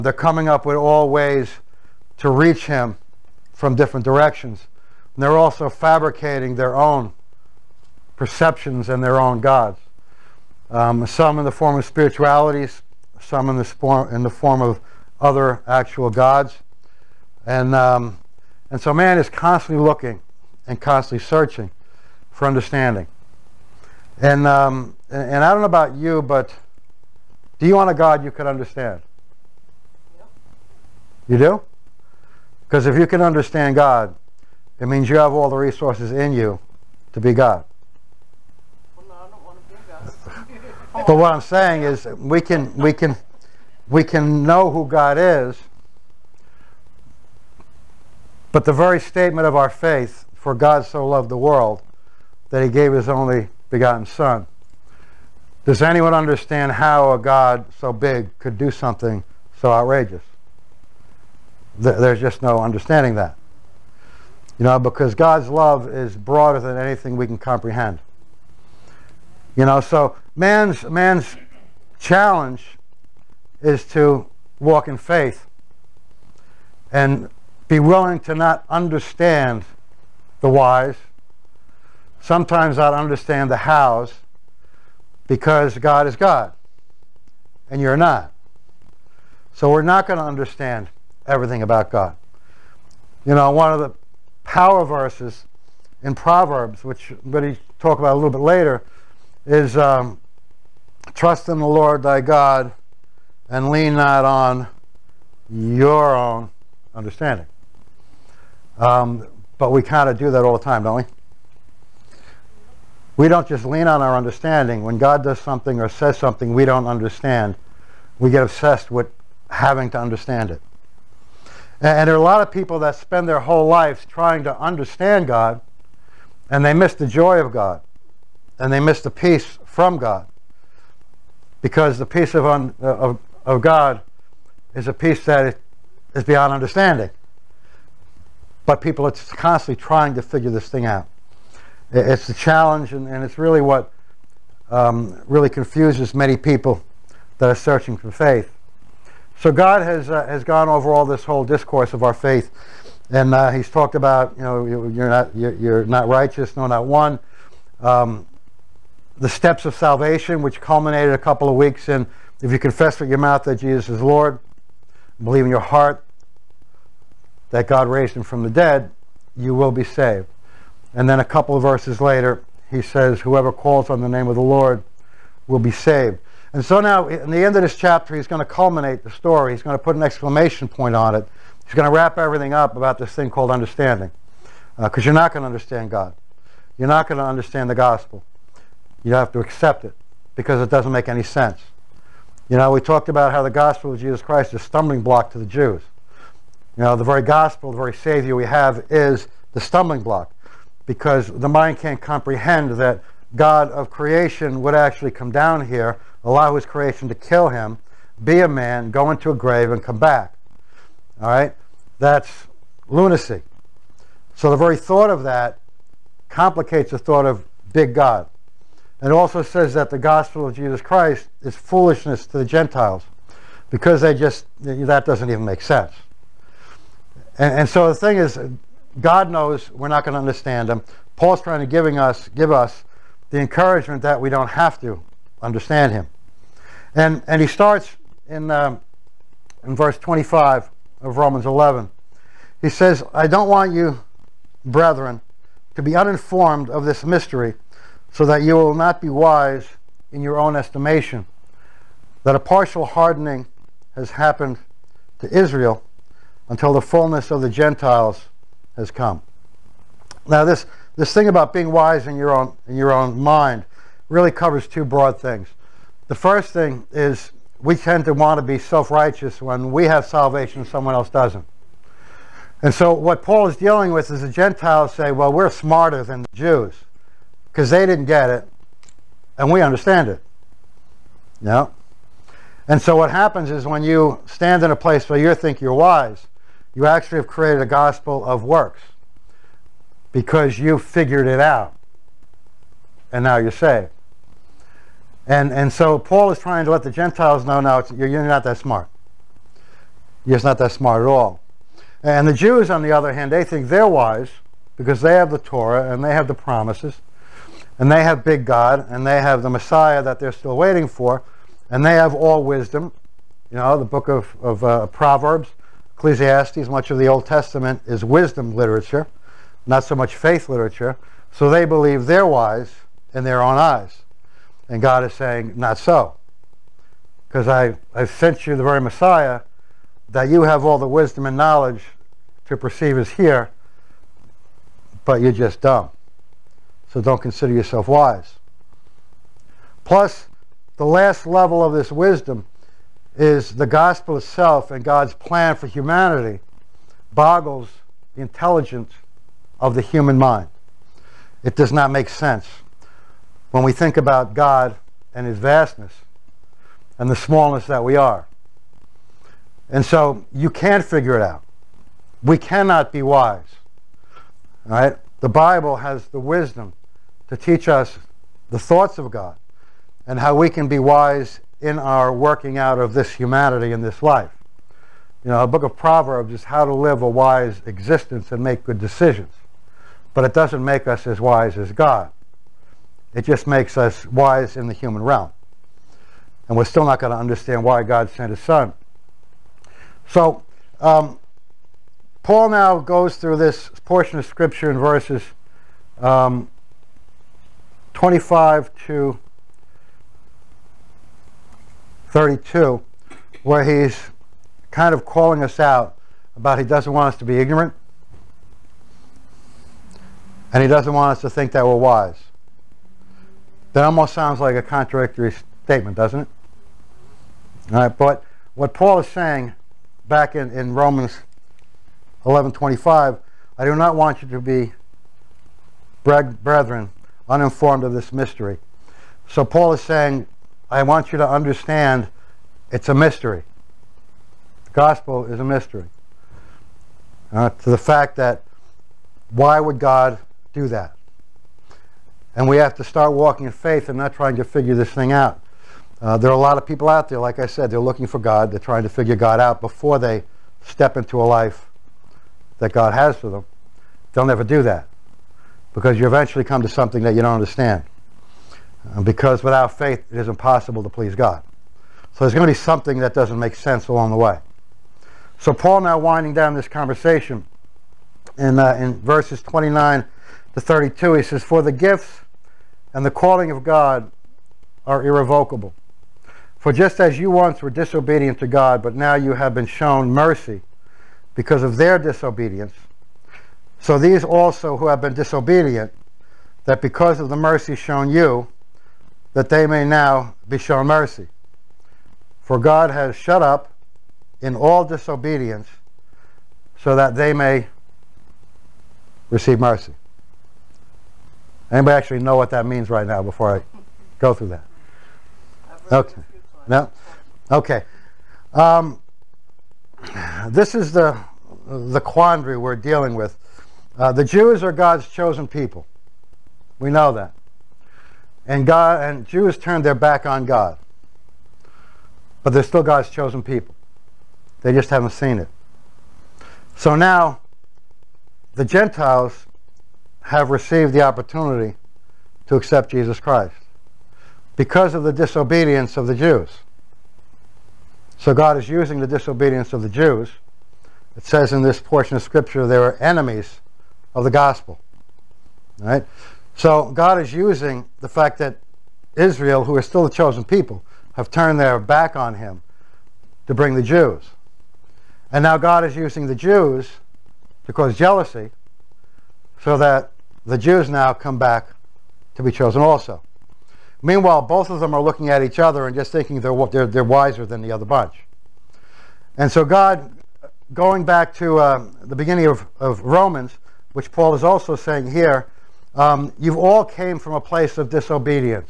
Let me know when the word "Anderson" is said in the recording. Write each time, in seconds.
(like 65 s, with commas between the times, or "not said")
not said.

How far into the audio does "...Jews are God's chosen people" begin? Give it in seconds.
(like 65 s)
514 s.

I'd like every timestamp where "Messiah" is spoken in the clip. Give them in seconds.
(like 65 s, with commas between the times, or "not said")
309 s, 328 s.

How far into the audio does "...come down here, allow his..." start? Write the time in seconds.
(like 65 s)
205 s.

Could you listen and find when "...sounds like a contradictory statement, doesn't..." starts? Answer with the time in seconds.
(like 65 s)
414 s.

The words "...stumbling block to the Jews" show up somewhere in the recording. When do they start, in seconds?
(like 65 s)
194 s.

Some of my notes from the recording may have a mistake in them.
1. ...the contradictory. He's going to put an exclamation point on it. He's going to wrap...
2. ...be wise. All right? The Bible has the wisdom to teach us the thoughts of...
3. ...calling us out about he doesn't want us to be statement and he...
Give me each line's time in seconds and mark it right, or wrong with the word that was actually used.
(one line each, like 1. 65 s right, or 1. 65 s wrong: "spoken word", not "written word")
1. 179 s wrong: "story", not "contradictory"
2. 362 s right
3. 405 s wrong: "ignorant", not "statement".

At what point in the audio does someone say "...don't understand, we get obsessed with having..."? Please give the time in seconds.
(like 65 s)
116 s.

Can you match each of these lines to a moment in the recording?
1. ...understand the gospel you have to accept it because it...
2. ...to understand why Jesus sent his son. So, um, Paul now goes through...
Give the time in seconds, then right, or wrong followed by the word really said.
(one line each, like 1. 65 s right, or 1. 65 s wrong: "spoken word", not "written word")
1. 187 s right
2. 387 s wrong: "God", not "Jesus".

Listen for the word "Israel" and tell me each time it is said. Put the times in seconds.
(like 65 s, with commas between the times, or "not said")
255 s, 549 s.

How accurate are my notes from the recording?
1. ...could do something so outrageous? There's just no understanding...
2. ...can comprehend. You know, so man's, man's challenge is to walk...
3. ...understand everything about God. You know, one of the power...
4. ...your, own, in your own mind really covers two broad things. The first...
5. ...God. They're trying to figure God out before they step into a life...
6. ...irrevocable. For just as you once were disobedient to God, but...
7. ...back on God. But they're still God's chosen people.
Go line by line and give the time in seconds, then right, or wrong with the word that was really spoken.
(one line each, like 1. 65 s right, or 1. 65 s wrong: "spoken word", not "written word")
1. 58 s right
2. 67 s right
3. 90 s right
4. 262 s right
5. 448 s right
6. 475 s right
7. 519 s right.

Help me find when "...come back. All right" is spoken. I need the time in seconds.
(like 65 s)
209 s.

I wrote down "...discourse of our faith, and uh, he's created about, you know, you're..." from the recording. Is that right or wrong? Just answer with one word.
wrong.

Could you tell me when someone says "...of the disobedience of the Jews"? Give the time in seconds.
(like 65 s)
534 s.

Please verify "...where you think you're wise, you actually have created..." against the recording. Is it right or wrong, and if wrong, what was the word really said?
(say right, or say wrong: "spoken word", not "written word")
right.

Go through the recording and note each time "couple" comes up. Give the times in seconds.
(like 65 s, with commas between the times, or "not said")
161 s, 171 s.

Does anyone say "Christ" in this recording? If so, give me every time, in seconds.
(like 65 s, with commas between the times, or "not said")
194 s, 220 s, 533 s.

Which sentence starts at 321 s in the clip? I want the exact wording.
So they believe they're wise in their own eyes.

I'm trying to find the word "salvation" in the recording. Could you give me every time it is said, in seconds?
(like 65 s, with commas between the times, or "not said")
159 s, 270 s.